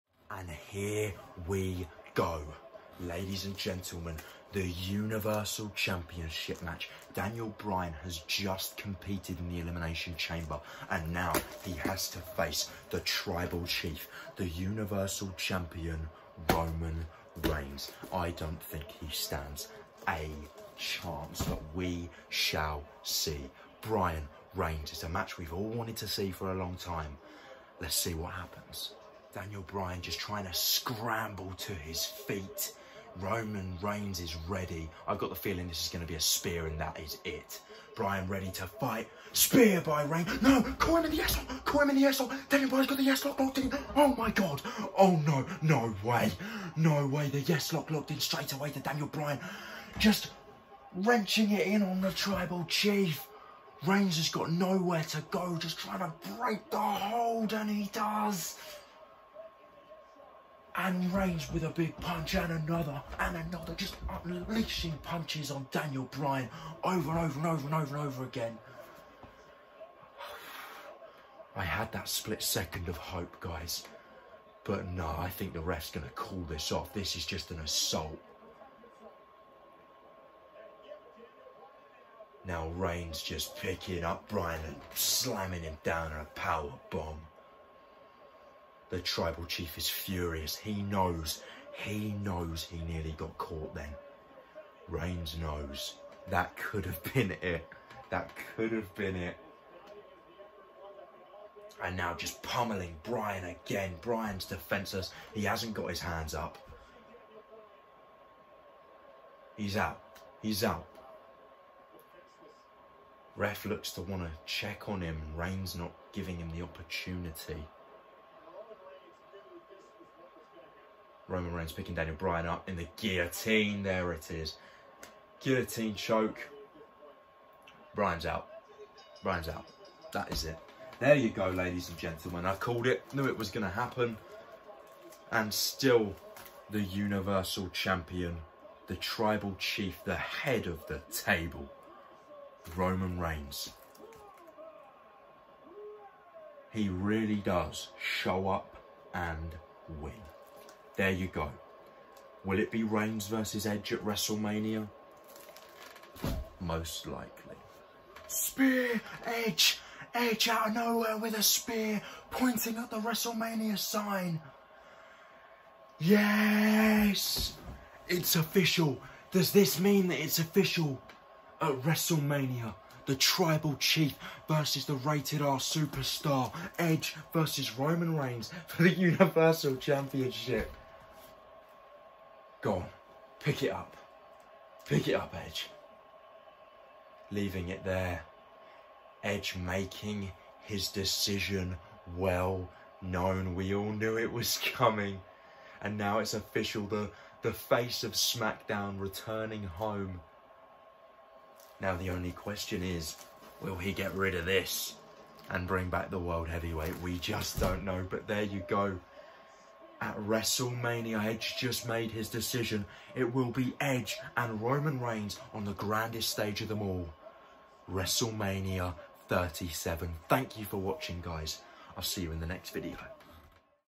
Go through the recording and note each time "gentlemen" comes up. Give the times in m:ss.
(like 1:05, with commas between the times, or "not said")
0:03, 2:11.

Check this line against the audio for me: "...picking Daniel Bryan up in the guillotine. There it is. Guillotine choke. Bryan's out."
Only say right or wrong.
right.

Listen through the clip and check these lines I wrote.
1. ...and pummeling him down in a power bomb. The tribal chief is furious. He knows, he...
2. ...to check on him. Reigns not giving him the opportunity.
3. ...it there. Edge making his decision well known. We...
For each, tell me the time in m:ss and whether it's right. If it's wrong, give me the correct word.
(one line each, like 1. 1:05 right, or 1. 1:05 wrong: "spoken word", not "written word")
1. 1:24 wrong: "slamming", not "pummeling"
2. 1:54 right
3. 3:07 right.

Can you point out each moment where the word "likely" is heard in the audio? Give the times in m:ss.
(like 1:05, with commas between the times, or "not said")
2:37.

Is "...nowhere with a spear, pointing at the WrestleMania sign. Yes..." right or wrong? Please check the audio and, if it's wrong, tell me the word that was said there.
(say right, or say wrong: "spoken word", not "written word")
right.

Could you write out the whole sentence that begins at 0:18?
I don't think he stands a chance, but we shall see.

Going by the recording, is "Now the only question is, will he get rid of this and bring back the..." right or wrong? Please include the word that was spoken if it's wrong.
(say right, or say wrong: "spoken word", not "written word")
right.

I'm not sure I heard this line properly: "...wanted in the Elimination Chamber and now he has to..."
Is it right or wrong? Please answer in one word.
wrong.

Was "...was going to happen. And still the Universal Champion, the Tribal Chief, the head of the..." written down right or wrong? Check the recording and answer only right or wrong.
right.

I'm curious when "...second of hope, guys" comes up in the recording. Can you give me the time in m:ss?
1:12.